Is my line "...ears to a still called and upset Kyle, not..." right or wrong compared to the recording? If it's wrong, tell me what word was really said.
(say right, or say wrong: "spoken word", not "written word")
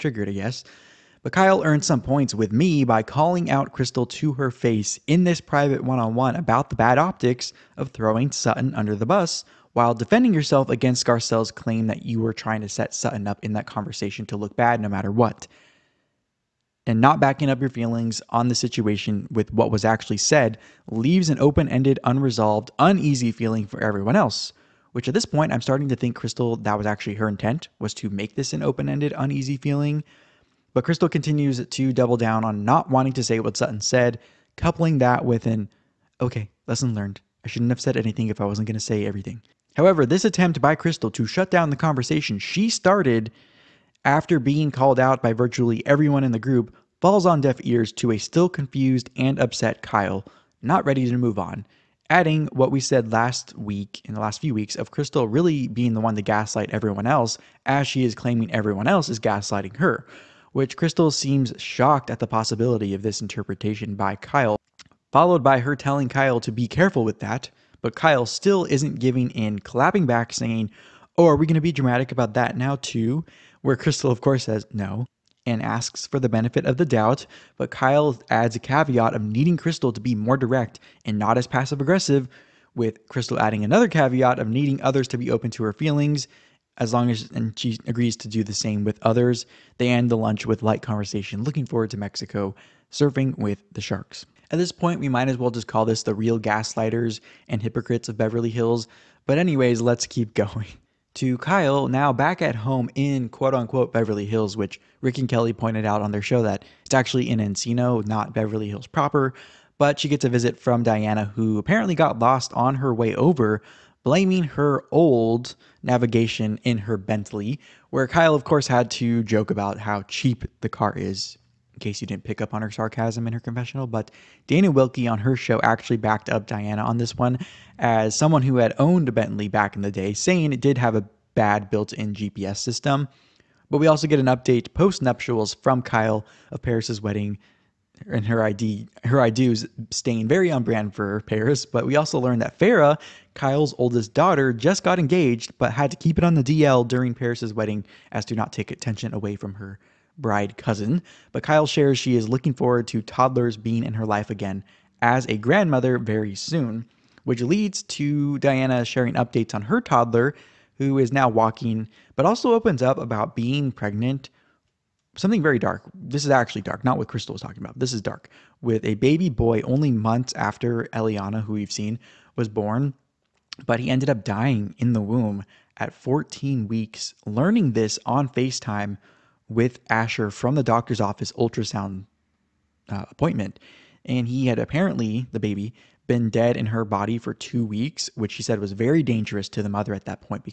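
wrong: "confused", not "called".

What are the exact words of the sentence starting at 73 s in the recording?
Where Crystal, of course, says no and asks for the benefit of the doubt.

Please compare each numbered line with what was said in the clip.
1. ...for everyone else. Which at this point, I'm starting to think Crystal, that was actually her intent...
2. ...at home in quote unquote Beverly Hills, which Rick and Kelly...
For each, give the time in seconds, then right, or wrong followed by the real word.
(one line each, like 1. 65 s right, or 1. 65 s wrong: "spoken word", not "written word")
1. 23 s right
2. 102 s right.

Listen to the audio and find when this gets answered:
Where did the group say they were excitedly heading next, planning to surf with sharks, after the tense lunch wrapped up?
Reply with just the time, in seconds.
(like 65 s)
91 s.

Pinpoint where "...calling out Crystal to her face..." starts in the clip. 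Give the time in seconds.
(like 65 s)
3 s.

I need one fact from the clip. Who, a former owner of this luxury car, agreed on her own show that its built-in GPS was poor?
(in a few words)
Dana Wilkey.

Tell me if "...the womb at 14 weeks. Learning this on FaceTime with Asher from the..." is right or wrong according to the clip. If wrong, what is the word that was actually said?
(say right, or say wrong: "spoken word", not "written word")
right.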